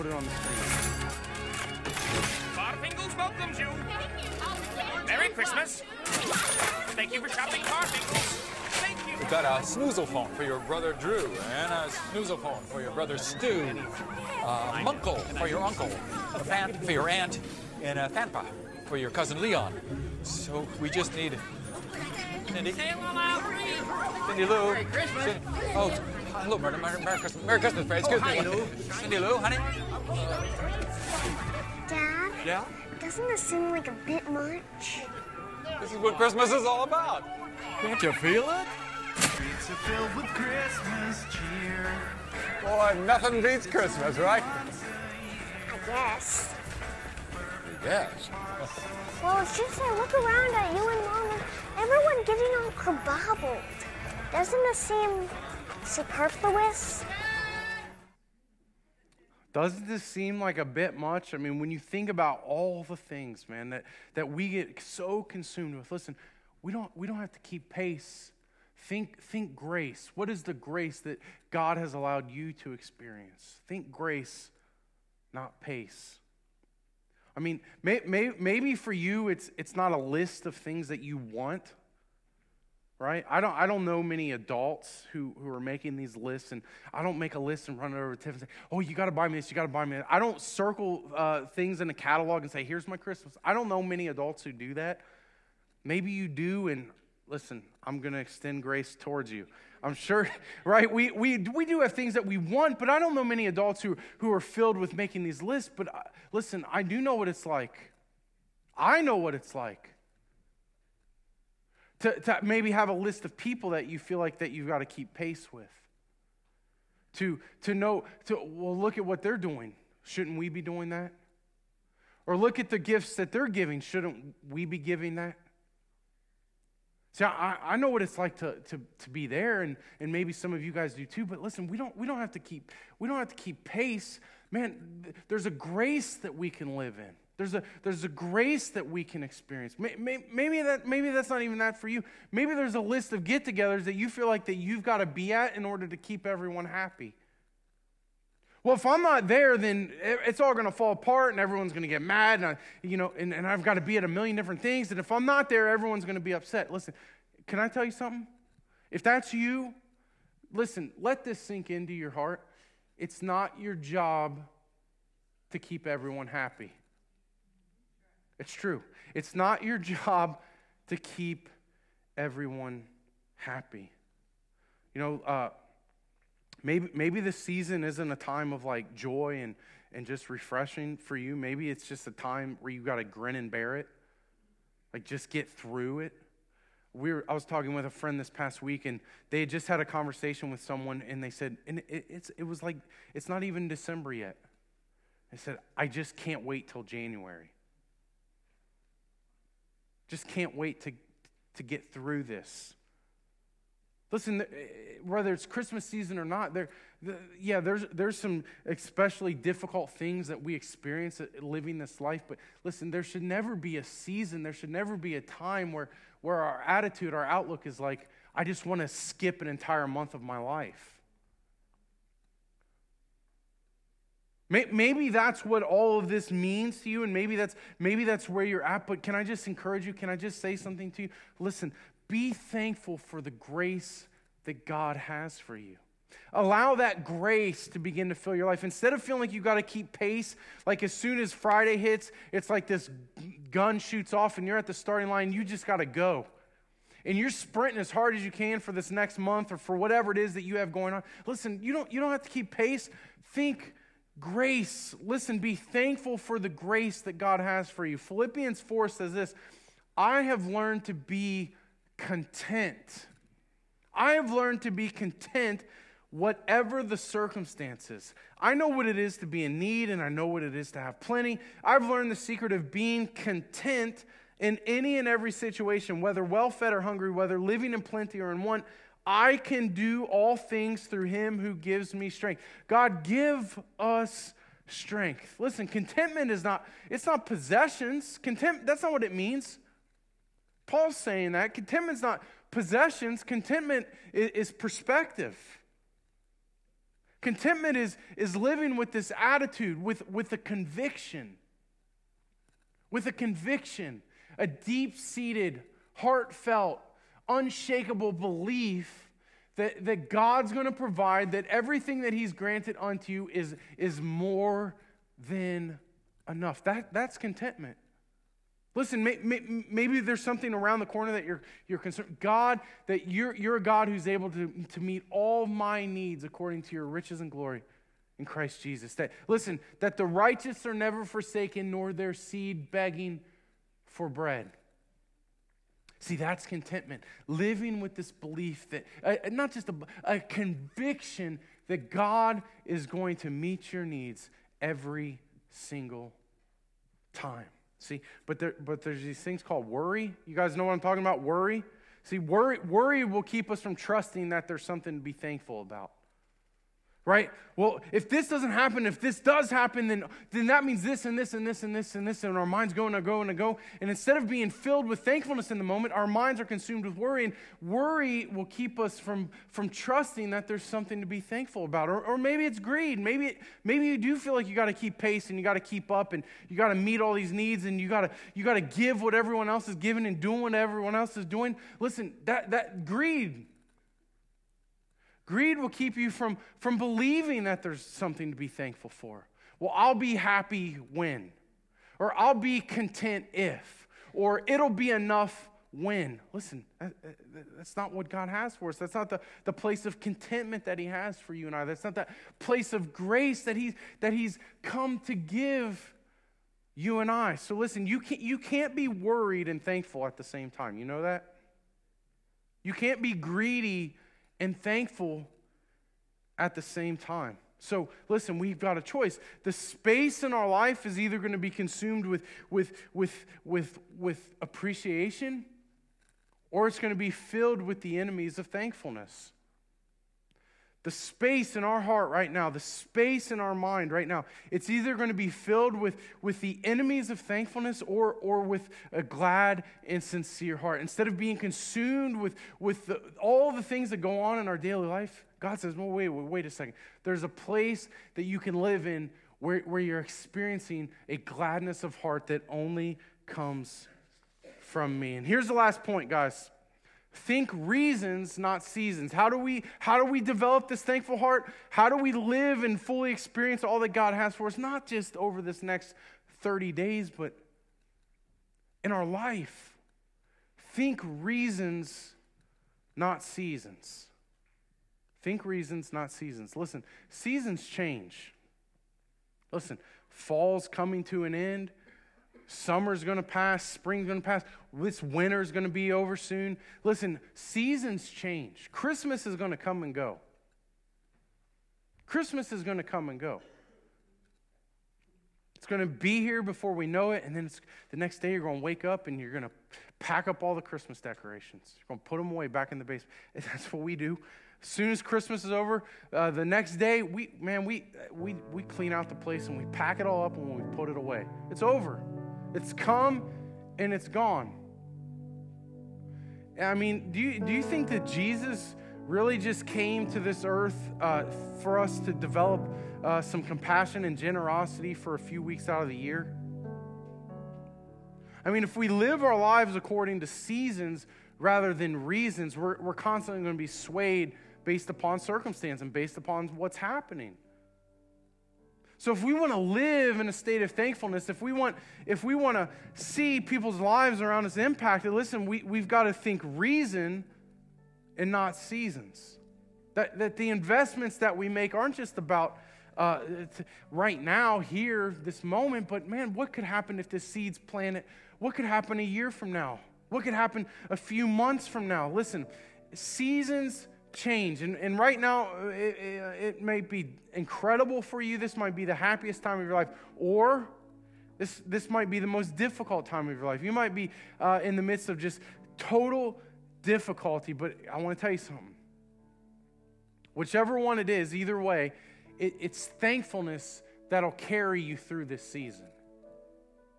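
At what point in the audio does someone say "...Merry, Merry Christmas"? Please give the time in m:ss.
0:26.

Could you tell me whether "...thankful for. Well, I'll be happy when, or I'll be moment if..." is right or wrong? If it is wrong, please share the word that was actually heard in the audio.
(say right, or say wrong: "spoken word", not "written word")
wrong: "content", not "moment".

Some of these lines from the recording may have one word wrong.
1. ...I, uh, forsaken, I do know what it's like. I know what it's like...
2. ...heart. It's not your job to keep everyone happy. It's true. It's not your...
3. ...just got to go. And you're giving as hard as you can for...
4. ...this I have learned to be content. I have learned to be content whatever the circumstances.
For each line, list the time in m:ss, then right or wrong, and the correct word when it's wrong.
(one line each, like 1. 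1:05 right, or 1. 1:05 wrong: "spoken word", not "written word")
1. 1:45 wrong: "listen", not "forsaken"
2. 2:42 right
3. 4:05 wrong: "sprinting", not "giving"
4. 4:19 right.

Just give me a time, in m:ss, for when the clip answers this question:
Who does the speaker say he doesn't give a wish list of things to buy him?
1:28.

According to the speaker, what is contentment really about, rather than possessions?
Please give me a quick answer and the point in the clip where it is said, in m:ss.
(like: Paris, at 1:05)
Perspective, at 4:54.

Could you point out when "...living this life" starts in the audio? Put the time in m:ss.
3:31.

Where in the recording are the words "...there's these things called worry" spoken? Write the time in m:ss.
5:48.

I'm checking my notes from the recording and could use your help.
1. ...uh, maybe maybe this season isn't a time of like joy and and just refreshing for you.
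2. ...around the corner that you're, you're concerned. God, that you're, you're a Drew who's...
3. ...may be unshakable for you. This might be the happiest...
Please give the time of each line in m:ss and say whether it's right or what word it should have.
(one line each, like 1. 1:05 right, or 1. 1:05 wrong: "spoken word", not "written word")
1. 2:55 right
2. 5:20 wrong: "God", not "Drew"
3. 9:26 wrong: "incredible", not "unshakable".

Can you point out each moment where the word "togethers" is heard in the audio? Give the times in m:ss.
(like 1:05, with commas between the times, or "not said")
2:23.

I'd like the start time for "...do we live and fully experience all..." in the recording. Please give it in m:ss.
7:41.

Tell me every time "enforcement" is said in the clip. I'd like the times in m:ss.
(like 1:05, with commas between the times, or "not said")
not said.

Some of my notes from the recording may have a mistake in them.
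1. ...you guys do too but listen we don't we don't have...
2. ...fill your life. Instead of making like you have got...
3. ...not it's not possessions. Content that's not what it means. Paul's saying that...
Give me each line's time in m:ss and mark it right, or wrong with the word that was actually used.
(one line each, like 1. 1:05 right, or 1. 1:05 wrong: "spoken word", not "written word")
1. 2:10 right
2. 3:58 wrong: "feeling", not "making"
3. 4:46 right.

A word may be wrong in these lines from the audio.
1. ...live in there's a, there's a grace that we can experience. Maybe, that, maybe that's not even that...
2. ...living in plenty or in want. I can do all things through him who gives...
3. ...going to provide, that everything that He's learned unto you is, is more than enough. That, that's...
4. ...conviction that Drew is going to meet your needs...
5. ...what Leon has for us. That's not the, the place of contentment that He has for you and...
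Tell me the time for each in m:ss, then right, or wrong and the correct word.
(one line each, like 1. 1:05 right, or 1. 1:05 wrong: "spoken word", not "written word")
1. 2:16 right
2. 4:37 right
3. 5:10 wrong: "granted", not "learned"
4. 5:40 wrong: "God", not "Drew"
5. 6:37 wrong: "God", not "Leon".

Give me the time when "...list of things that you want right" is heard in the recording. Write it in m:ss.
1:19.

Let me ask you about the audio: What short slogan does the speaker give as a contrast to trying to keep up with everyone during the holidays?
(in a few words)
Think grace, not pace.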